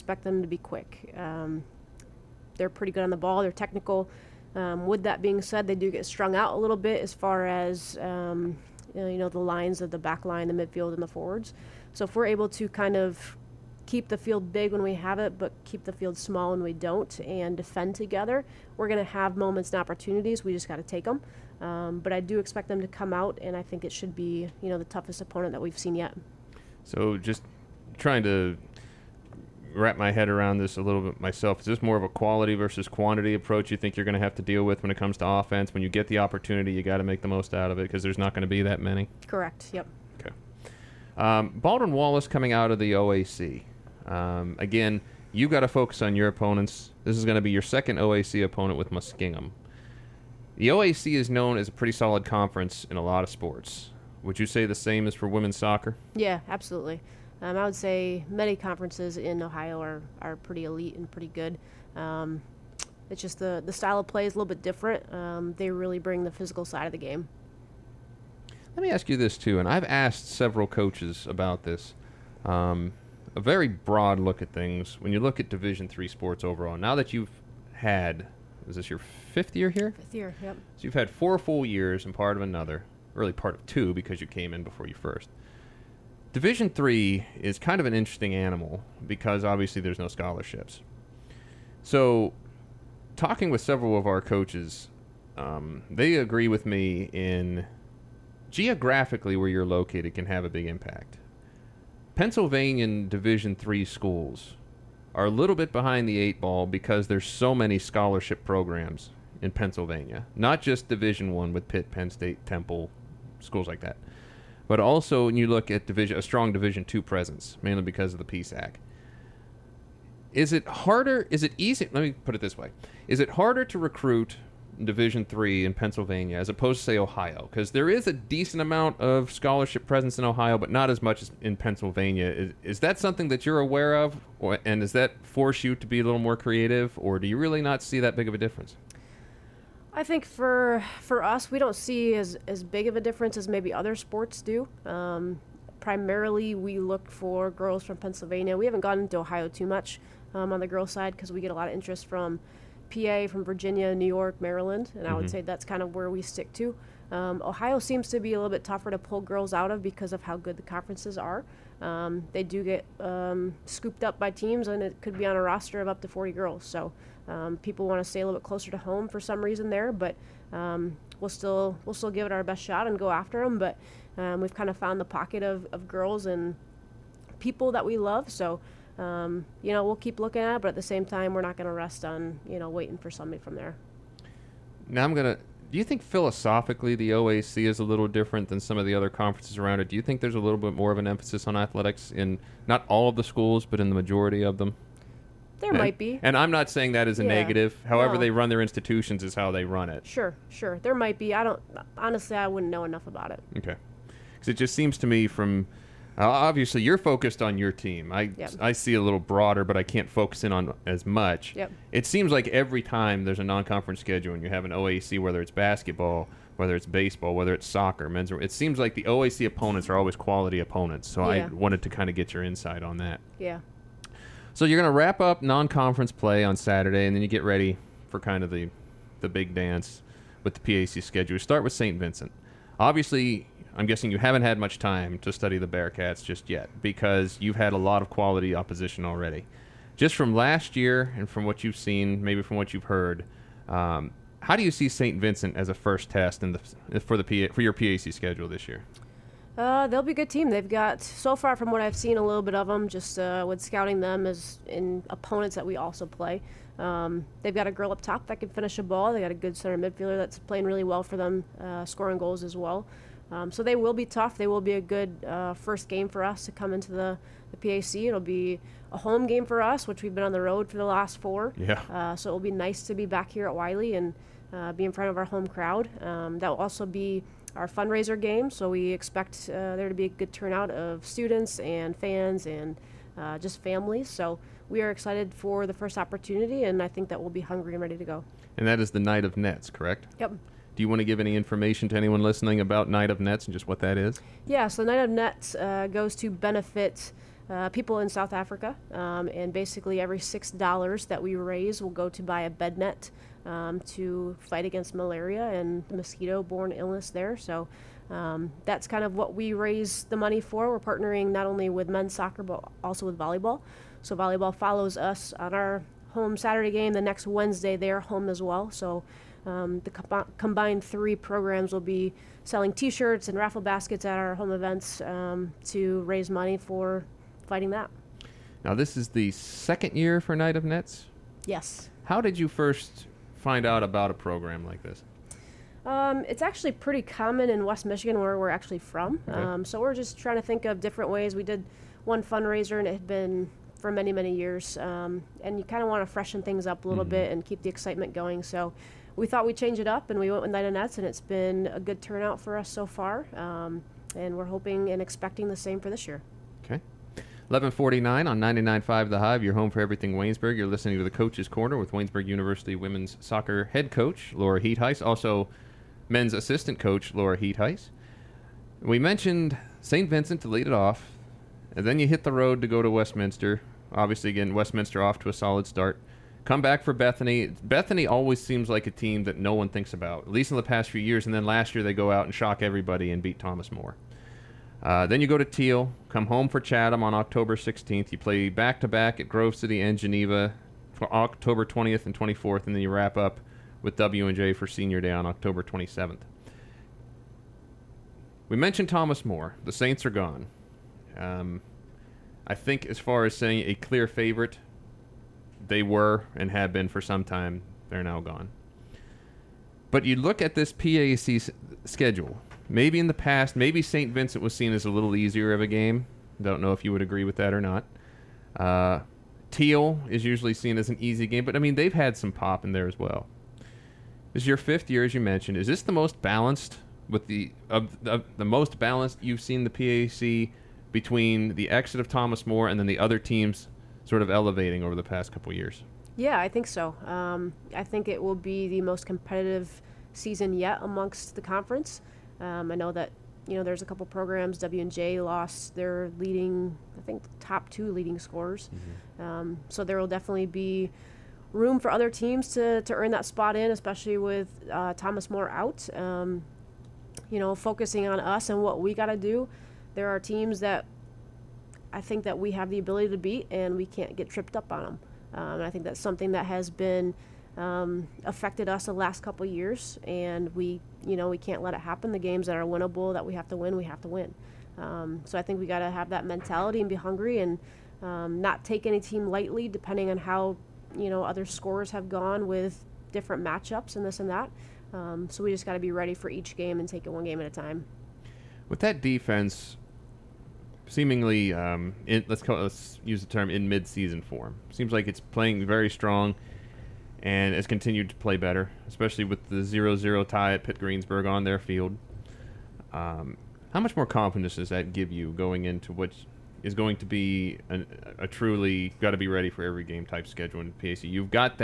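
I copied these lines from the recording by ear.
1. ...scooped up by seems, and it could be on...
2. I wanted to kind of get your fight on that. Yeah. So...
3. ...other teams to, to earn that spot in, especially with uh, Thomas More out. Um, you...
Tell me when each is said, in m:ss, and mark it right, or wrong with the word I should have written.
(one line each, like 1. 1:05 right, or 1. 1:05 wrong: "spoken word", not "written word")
1. 2:43 wrong: "teams", not "seems"
2. 3:41 wrong: "insight", not "fight"
3. 7:31 right.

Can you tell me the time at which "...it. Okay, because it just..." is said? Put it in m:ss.
3:23.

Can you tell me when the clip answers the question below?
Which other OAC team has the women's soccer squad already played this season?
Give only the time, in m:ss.
0:48.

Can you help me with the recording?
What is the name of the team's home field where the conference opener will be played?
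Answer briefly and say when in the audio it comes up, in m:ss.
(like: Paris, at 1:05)
Wiley, at 4:33.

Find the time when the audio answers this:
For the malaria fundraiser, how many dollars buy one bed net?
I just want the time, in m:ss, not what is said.
5:00.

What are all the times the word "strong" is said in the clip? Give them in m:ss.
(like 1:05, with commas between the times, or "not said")
1:56, 8:15.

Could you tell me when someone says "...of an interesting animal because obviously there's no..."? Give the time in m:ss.
1:27.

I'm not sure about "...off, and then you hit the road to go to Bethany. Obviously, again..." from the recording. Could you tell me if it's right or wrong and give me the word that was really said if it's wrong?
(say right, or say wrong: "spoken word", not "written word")
wrong: "Westminster", not "Bethany".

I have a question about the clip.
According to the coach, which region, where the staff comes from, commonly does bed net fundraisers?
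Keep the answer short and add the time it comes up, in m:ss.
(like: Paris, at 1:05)
West Michigan, at 5:37.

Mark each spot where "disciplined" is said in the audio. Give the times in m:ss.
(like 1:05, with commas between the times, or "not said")
not said.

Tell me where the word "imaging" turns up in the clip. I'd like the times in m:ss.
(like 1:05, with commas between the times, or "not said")
not said.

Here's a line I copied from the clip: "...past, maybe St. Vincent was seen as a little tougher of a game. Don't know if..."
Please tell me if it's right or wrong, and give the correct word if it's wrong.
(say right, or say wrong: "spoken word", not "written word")
wrong: "easier", not "tougher".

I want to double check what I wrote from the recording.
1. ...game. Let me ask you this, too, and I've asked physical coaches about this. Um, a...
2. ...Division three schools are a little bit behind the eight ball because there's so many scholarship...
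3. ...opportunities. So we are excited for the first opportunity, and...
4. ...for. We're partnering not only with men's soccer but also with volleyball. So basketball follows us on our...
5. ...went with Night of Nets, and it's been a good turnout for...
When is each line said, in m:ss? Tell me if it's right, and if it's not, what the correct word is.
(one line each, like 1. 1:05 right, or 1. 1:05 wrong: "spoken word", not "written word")
1. 1:06 wrong: "several", not "physical"
2. 1:43 right
3. 4:43 wrong: "families", not "opportunities"
4. 5:10 wrong: "volleyball", not "basketball"
5. 5:50 right.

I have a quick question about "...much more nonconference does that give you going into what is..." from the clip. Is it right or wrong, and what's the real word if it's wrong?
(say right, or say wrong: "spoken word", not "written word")
wrong: "confidence", not "nonconference".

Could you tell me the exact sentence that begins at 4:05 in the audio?
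Vincent as a first test in the for the PA, for your PAC schedule this year?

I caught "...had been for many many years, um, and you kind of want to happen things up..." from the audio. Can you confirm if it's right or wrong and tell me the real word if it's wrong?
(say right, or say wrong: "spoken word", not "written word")
wrong: "freshen", not "happen".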